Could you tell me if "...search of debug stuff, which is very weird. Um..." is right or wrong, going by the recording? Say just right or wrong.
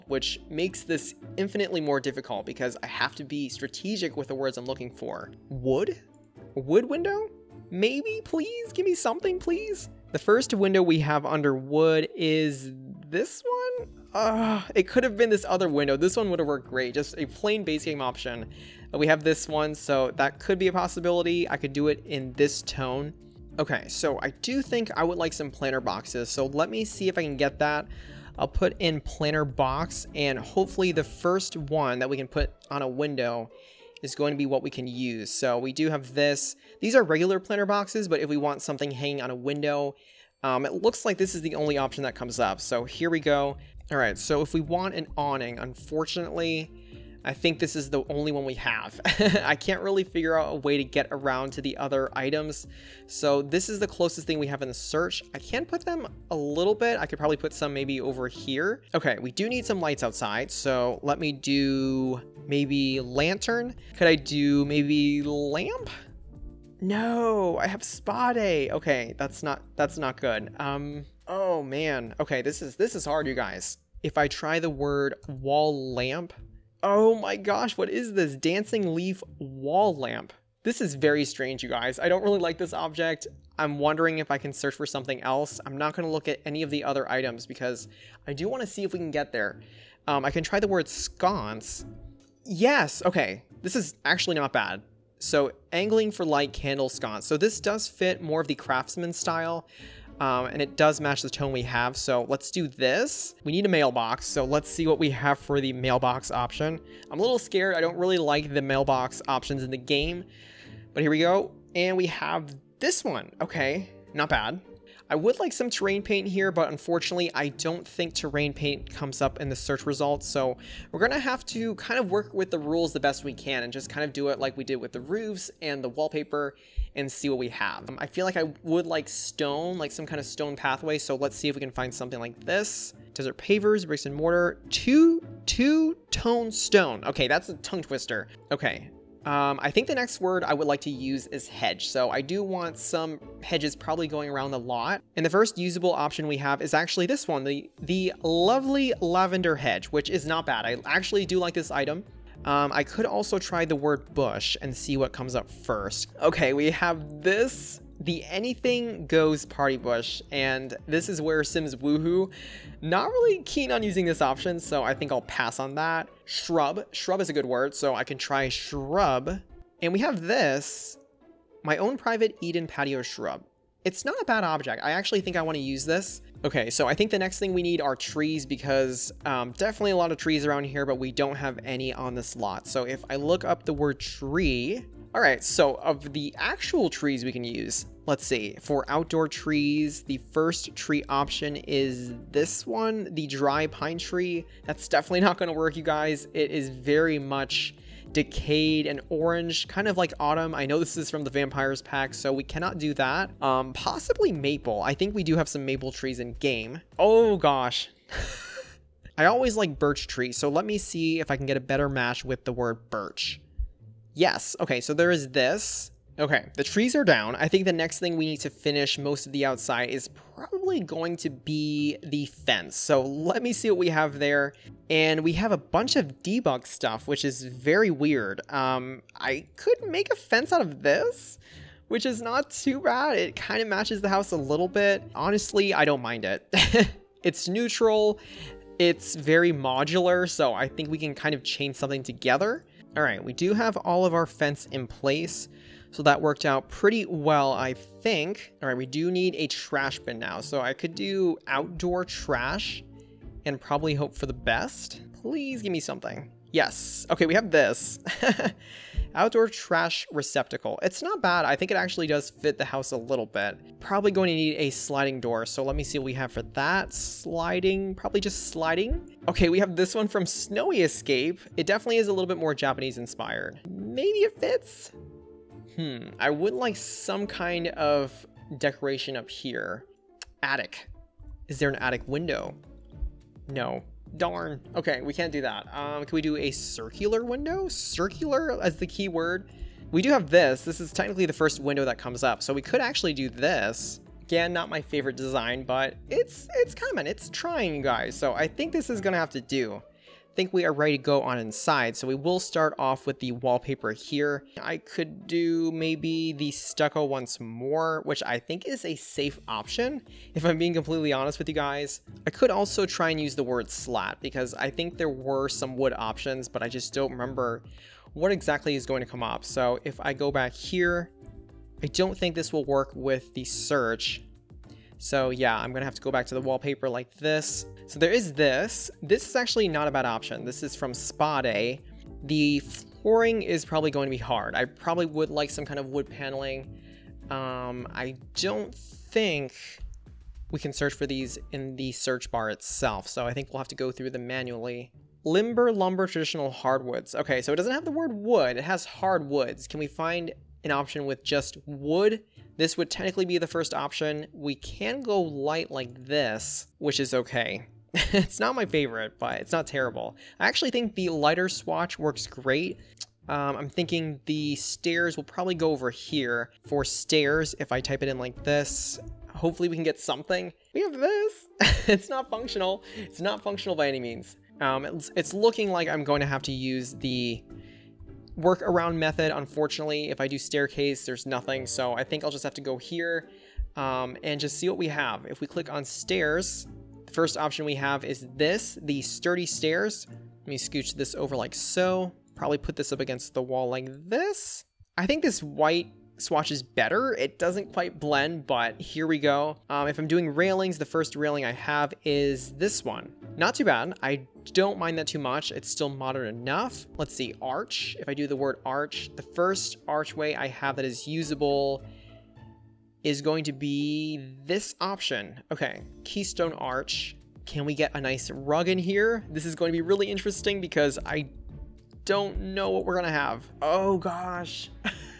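wrong.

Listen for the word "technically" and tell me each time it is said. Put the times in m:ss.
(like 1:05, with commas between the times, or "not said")
4:50, 5:52.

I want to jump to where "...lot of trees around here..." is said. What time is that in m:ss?
2:59.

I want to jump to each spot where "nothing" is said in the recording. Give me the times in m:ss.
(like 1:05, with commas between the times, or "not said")
6:21.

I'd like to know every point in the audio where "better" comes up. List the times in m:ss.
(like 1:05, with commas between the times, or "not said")
3:31, 6:36.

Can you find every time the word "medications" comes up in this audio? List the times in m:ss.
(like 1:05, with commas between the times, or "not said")
not said.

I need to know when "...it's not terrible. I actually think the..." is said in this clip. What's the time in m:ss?
5:59.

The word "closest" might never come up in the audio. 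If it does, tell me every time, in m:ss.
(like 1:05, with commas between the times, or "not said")
0:53.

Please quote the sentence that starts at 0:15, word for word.
This one would have worked great.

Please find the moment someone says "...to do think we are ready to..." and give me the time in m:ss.
4:59.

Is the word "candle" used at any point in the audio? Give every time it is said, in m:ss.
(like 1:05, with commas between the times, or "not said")
1:36.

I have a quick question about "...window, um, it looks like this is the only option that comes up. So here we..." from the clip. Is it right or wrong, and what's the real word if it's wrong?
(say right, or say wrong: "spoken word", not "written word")
right.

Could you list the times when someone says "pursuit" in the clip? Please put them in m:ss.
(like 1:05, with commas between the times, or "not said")
not said.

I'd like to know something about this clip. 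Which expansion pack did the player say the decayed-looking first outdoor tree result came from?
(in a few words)
vampires pack.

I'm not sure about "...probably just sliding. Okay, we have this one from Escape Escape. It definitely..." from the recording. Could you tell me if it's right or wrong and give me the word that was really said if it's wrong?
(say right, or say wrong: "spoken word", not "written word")
wrong: "Snowy", not "Escape".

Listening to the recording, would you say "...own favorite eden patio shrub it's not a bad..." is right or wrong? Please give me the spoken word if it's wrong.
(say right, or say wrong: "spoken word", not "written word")
wrong: "private", not "favorite".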